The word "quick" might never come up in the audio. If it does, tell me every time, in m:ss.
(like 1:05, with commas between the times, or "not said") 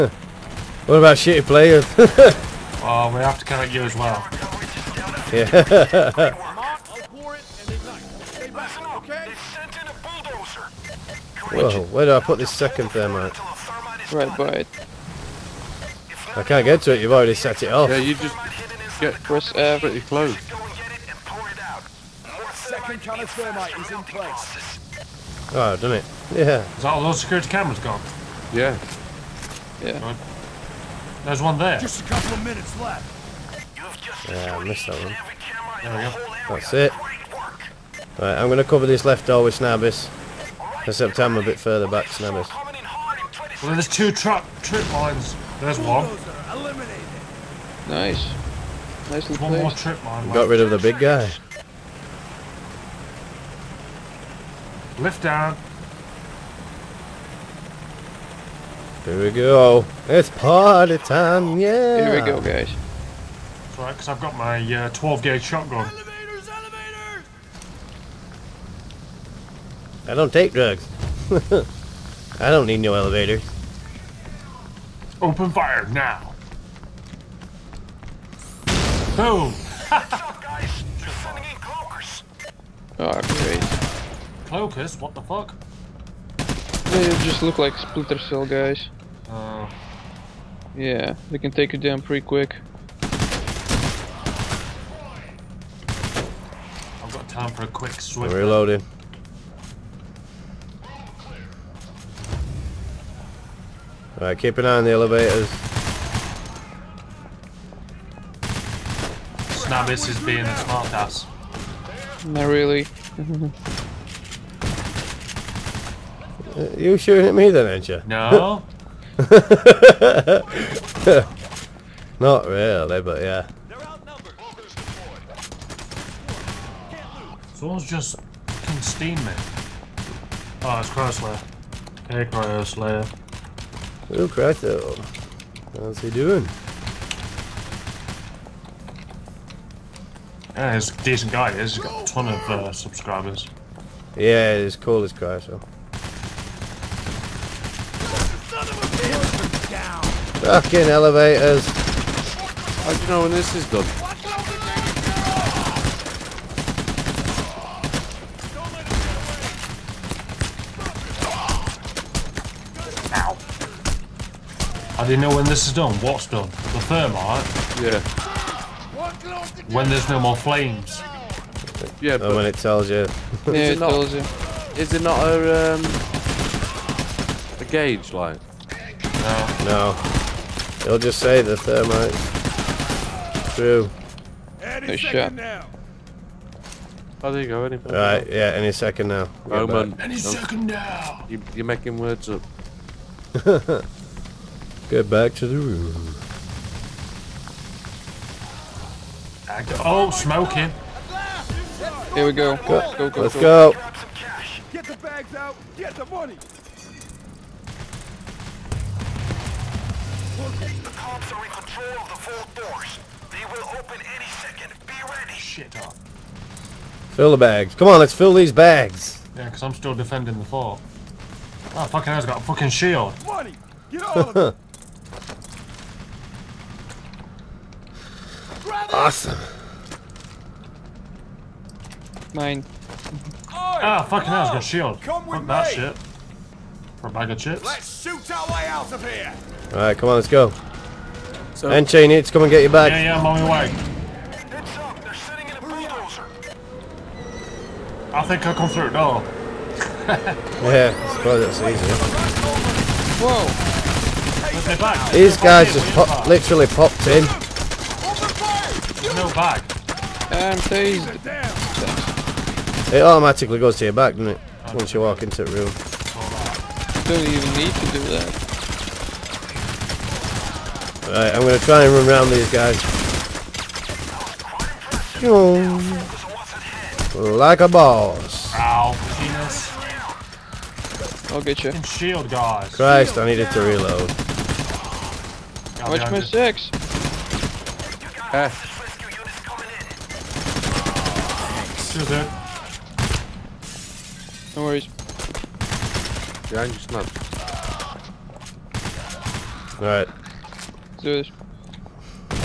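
1:32, 1:37.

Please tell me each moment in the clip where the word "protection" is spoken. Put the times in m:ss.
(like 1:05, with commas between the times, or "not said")
not said.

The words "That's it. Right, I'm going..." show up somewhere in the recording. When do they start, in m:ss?
0:36.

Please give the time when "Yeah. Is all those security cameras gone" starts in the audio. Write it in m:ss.
0:26.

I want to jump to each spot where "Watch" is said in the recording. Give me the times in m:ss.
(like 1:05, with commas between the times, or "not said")
4:45.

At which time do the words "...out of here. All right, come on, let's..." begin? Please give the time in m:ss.
3:58.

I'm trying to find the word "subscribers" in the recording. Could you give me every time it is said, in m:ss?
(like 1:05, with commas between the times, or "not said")
2:22.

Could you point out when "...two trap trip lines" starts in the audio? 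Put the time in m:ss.
0:43.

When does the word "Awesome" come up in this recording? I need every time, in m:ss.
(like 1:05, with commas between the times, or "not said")
3:48.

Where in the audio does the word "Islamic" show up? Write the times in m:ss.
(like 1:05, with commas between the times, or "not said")
not said.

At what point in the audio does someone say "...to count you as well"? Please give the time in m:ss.
0:03.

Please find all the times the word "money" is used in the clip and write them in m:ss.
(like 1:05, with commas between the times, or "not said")
3:26, 3:43.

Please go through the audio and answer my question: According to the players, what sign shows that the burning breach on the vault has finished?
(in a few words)
no more flames.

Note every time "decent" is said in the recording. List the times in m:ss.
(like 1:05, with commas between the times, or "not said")
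2:21.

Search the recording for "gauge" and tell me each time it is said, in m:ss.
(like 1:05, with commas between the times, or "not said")
1:05, 2:57.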